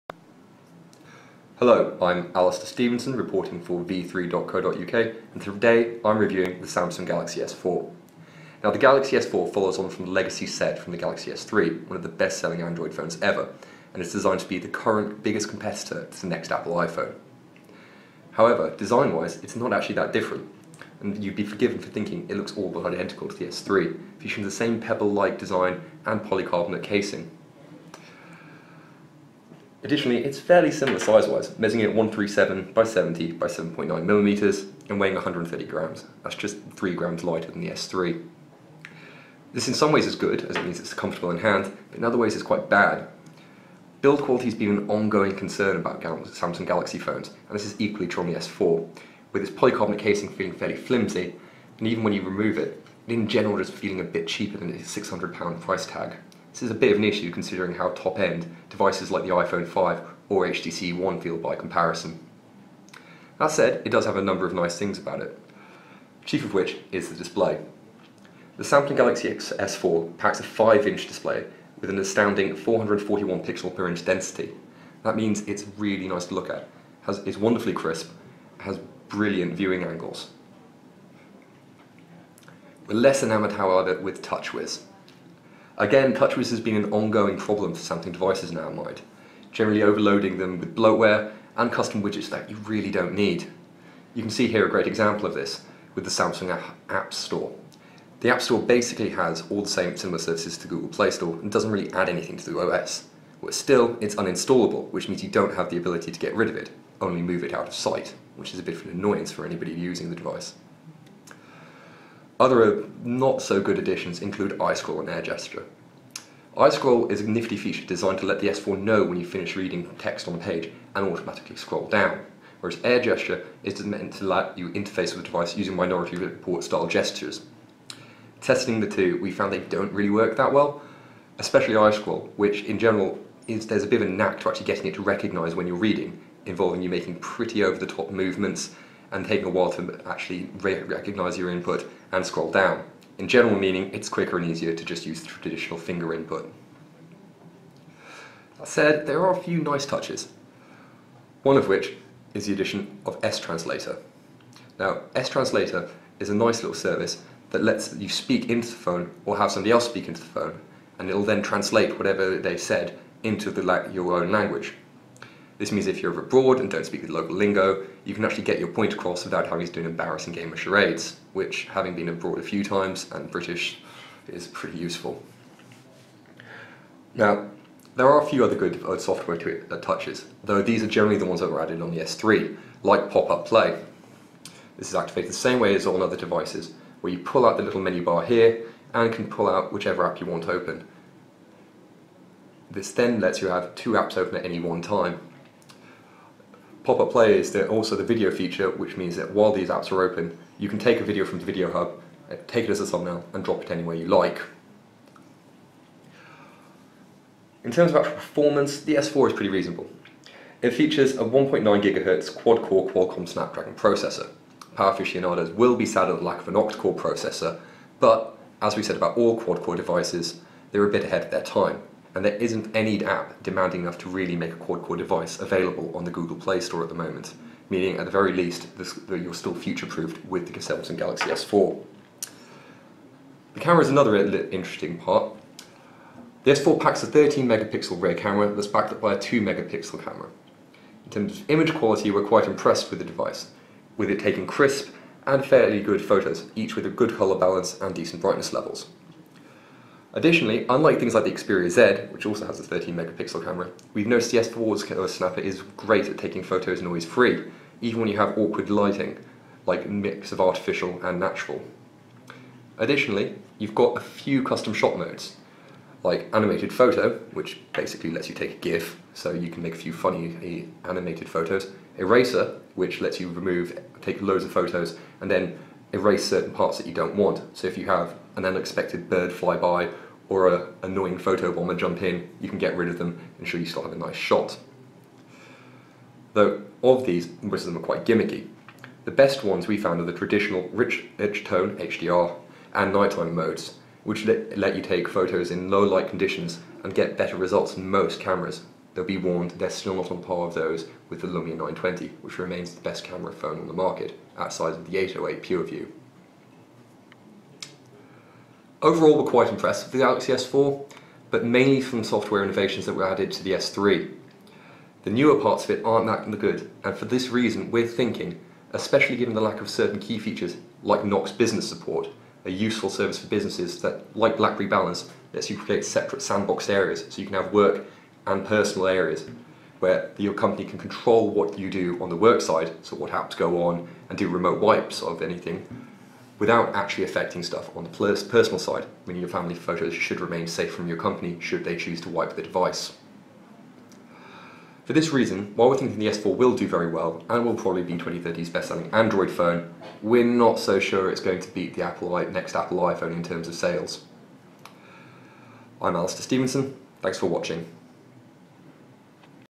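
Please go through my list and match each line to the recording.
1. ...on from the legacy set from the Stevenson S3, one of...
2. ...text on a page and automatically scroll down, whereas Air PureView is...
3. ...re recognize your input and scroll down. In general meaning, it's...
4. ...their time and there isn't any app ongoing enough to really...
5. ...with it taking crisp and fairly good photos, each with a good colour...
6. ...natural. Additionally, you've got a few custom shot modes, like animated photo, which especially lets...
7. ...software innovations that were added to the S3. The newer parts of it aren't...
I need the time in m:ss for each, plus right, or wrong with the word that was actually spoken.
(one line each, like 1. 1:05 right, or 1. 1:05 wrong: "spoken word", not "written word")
1. 0:09 wrong: "Galaxy", not "Stevenson"
2. 1:59 wrong: "Gesture", not "PureView"
3. 2:20 right
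4. 3:41 wrong: "demanding", not "ongoing"
5. 4:03 right
6. 4:21 wrong: "basically", not "especially"
7. 5:12 right.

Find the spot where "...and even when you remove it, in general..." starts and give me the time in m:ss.
0:51.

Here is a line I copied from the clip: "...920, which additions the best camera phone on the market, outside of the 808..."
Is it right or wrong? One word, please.
wrong.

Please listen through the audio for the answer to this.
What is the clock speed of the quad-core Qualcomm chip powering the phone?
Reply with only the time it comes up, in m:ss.
3:31.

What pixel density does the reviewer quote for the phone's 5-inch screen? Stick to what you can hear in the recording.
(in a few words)
441 pixels per inch.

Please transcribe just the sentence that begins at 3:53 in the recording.
The camera is another interesting part.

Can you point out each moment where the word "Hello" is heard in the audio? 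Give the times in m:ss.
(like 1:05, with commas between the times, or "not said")
0:01.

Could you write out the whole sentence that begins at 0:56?
This is a bit of an issue considering how top-end devices like the iPhone 5 or HTC One feel by comparison.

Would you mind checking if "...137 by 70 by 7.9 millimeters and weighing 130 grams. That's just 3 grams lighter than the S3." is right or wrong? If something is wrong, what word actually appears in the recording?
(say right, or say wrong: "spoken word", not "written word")
right.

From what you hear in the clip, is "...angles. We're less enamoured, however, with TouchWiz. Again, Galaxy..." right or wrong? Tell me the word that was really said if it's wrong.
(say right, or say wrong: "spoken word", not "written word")
wrong: "TouchWiz", not "Galaxy".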